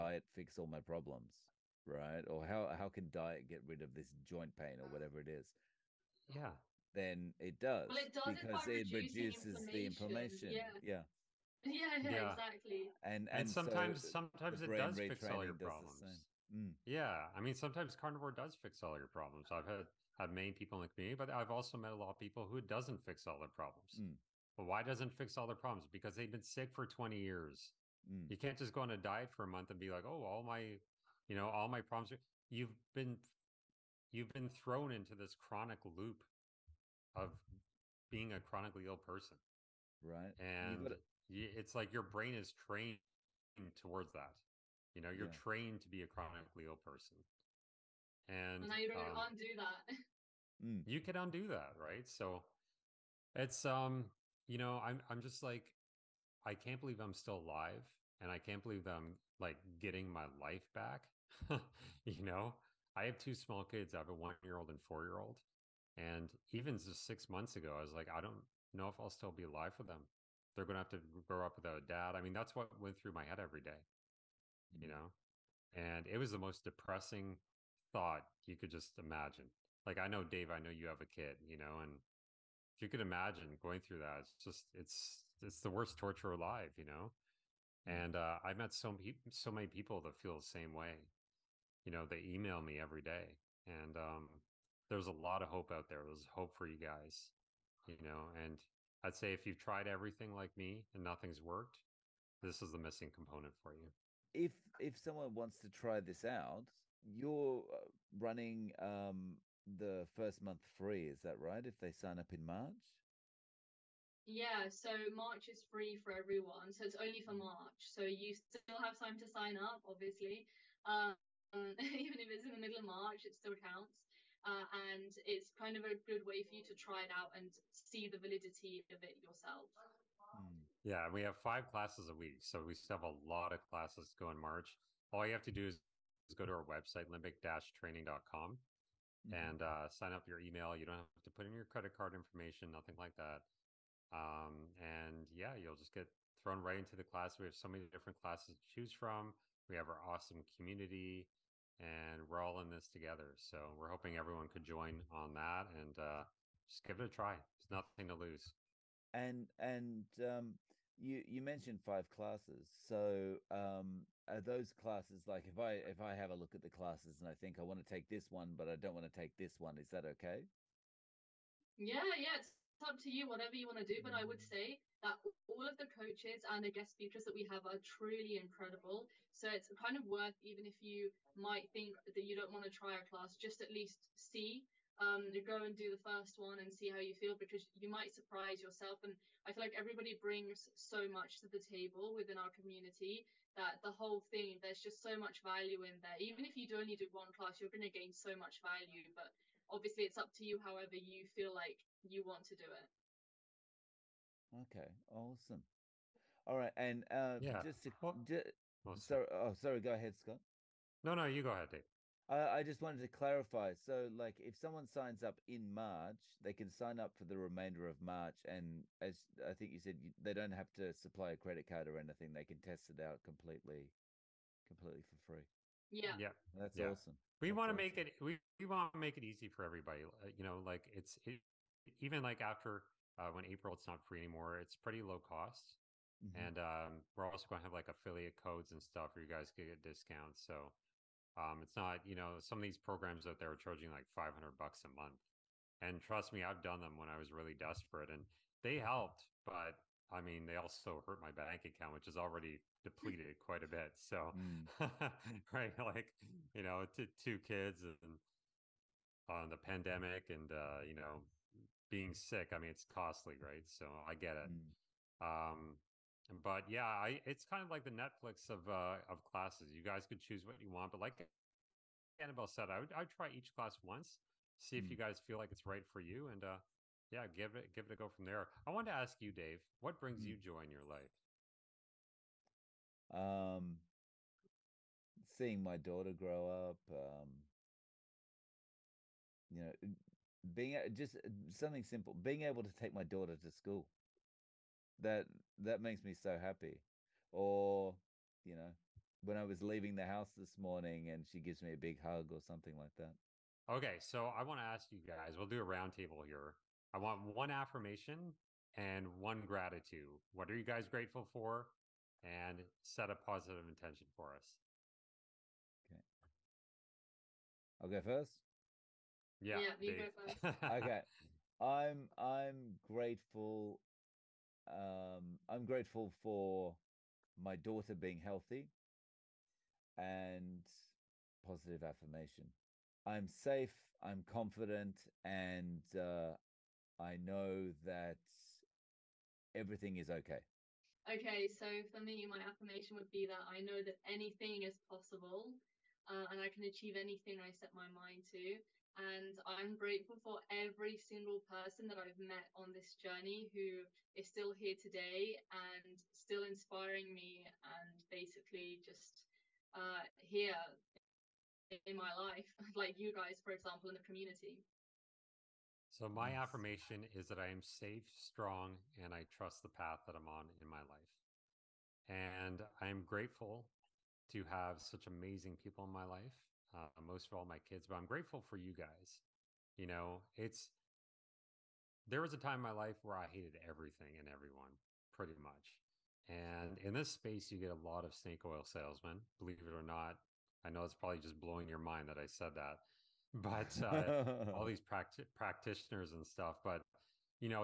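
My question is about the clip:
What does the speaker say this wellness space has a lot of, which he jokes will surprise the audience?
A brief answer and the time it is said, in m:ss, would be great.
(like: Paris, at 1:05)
Snake oil salesmen, at 6:28.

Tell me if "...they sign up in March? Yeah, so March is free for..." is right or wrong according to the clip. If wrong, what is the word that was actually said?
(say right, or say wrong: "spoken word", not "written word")
right.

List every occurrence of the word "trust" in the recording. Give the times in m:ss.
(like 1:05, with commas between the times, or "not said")
4:06, 6:09.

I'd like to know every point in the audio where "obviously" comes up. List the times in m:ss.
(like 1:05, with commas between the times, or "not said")
1:59, 3:19.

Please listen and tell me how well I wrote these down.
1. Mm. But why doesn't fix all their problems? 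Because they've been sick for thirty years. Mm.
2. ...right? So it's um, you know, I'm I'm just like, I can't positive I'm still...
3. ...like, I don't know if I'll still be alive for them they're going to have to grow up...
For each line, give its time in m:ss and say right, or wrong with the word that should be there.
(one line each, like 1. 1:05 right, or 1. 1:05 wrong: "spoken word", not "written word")
1. 0:23 wrong: "twenty", not "thirty"
2. 0:51 wrong: "believe", not "positive"
3. 1:07 right.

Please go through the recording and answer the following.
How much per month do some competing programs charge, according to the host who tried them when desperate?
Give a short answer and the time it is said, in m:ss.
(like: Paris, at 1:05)
$500, at 4:04.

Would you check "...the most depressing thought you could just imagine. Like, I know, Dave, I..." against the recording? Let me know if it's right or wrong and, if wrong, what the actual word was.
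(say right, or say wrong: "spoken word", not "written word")
right.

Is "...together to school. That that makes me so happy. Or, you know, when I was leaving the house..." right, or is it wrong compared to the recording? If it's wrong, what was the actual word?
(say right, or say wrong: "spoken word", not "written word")
wrong: "daughter", not "together".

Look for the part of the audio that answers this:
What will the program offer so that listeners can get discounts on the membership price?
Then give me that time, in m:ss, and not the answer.
3:57.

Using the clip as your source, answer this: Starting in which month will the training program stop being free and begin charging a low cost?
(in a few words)
April.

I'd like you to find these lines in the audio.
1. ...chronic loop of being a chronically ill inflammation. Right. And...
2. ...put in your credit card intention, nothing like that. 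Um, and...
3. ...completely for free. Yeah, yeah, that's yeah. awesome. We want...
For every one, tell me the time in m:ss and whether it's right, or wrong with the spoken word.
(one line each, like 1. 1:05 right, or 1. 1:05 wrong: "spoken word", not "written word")
1. 0:35 wrong: "person", not "inflammation"
2. 2:21 wrong: "information", not "intention"
3. 3:44 right.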